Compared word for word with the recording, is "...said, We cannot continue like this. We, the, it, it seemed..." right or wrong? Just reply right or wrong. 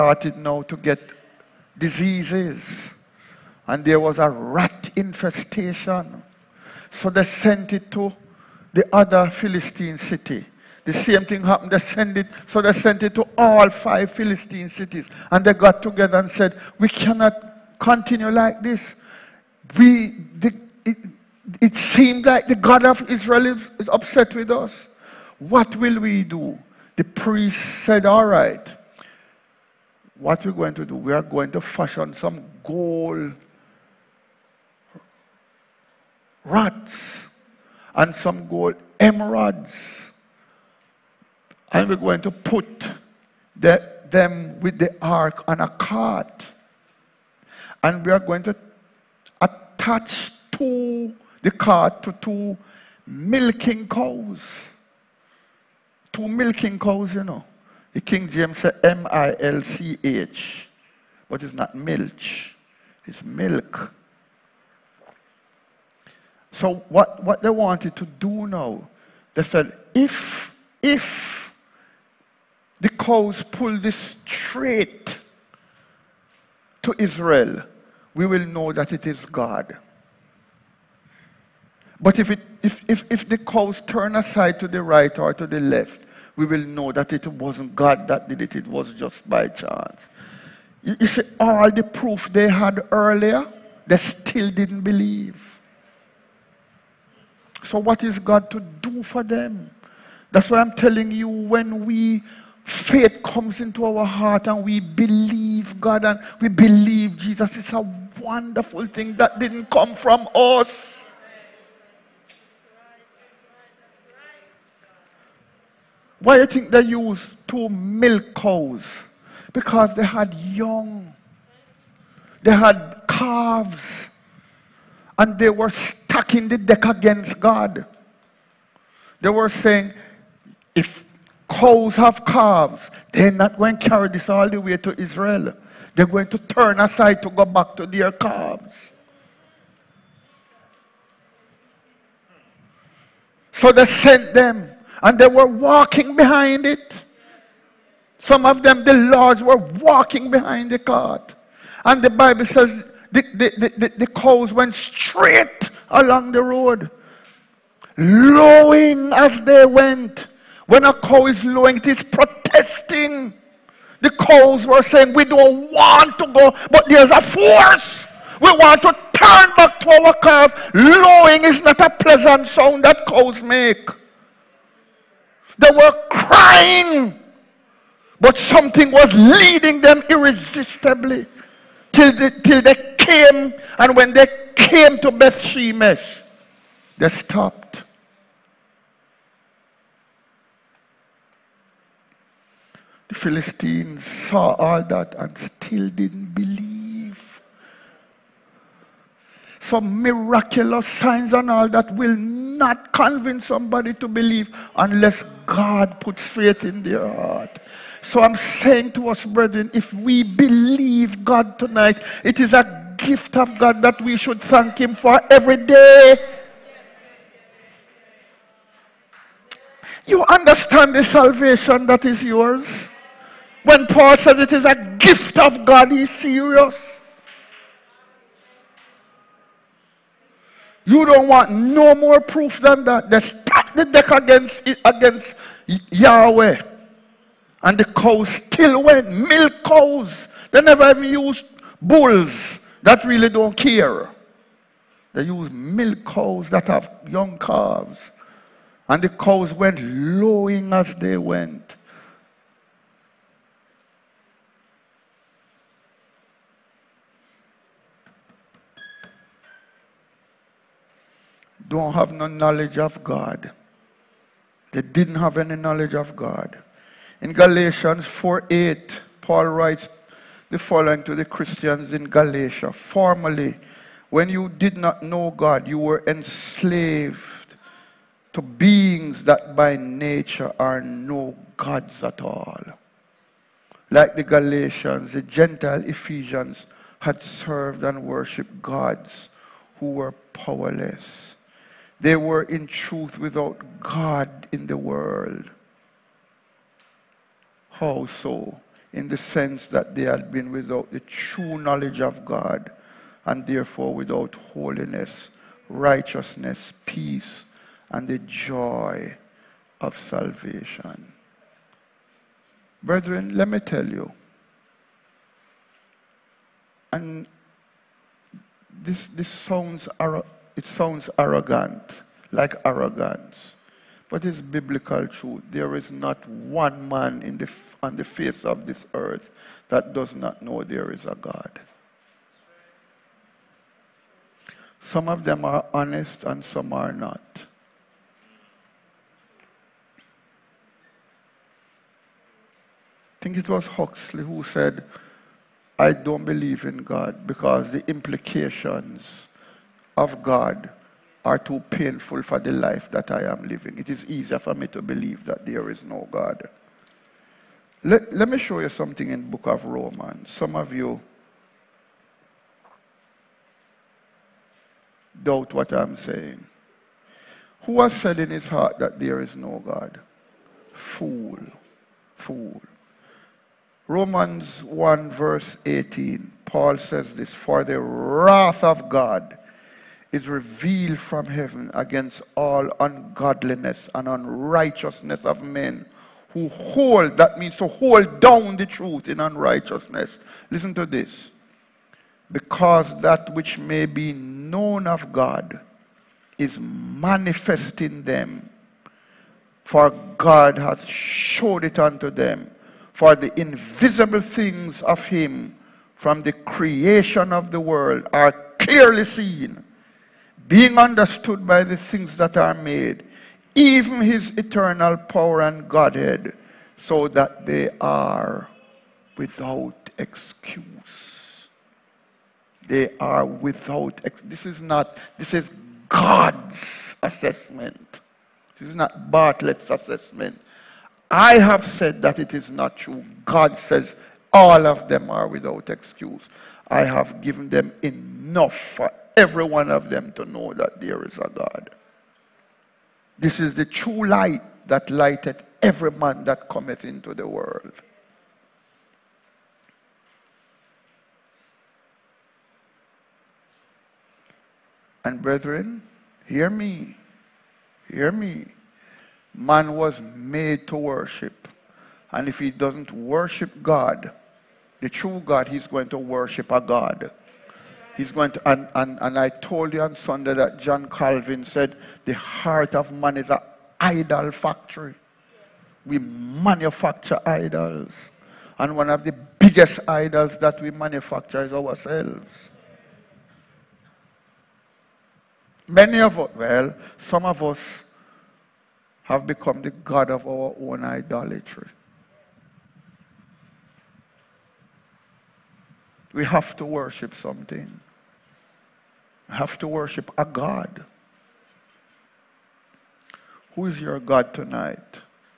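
right.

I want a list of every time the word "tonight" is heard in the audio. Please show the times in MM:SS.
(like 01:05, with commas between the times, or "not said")
03:31, 08:24.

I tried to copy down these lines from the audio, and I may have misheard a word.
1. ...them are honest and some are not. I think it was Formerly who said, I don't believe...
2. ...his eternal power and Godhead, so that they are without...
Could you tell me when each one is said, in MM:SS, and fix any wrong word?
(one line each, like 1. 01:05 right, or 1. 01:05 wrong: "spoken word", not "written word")
1. 05:35 wrong: "Huxley", not "Formerly"
2. 06:54 right.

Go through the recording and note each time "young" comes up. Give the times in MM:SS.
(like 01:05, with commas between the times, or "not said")
02:00, 04:07.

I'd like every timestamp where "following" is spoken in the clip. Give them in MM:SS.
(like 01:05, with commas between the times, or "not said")
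04:30.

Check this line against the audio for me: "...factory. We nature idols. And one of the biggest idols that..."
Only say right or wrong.
wrong.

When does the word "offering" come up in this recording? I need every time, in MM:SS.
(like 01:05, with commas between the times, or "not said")
not said.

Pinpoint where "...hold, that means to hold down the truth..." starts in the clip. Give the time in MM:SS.
06:26.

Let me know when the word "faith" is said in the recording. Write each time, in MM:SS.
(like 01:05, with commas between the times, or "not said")
01:42, 03:26.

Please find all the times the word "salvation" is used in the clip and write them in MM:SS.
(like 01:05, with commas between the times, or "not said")
03:41, 05:09.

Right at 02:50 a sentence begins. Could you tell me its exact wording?
Lowing is not a pleasant sound that cows make.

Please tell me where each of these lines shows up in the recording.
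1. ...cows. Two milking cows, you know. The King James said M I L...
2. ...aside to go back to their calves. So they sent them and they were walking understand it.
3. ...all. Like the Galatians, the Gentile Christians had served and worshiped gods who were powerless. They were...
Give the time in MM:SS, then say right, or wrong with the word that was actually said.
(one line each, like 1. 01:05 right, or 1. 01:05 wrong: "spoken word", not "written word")
1. 00:53 right
2. 02:16 wrong: "behind", not "understand"
3. 04:42 wrong: "Ephesians", not "Christians".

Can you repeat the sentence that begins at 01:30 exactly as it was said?
You, you see, all the proof they had earlier, they still didn't believe.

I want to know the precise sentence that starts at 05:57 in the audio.
Let, let me show you something in book of Romans.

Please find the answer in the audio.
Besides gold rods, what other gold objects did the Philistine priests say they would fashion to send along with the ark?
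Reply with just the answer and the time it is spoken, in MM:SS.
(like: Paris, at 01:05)
gold emeralds, at 00:38.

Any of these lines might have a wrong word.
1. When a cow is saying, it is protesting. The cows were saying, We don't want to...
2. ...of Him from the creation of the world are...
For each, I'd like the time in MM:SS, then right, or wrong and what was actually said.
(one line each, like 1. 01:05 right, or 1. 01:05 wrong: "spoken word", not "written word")
1. 02:40 wrong: "lowing", not "saying"
2. 06:44 right.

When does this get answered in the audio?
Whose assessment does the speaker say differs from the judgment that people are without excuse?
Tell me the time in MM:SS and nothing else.
07:09.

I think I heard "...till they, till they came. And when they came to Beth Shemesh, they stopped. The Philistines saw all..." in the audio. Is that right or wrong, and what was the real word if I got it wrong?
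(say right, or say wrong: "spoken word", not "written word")
right.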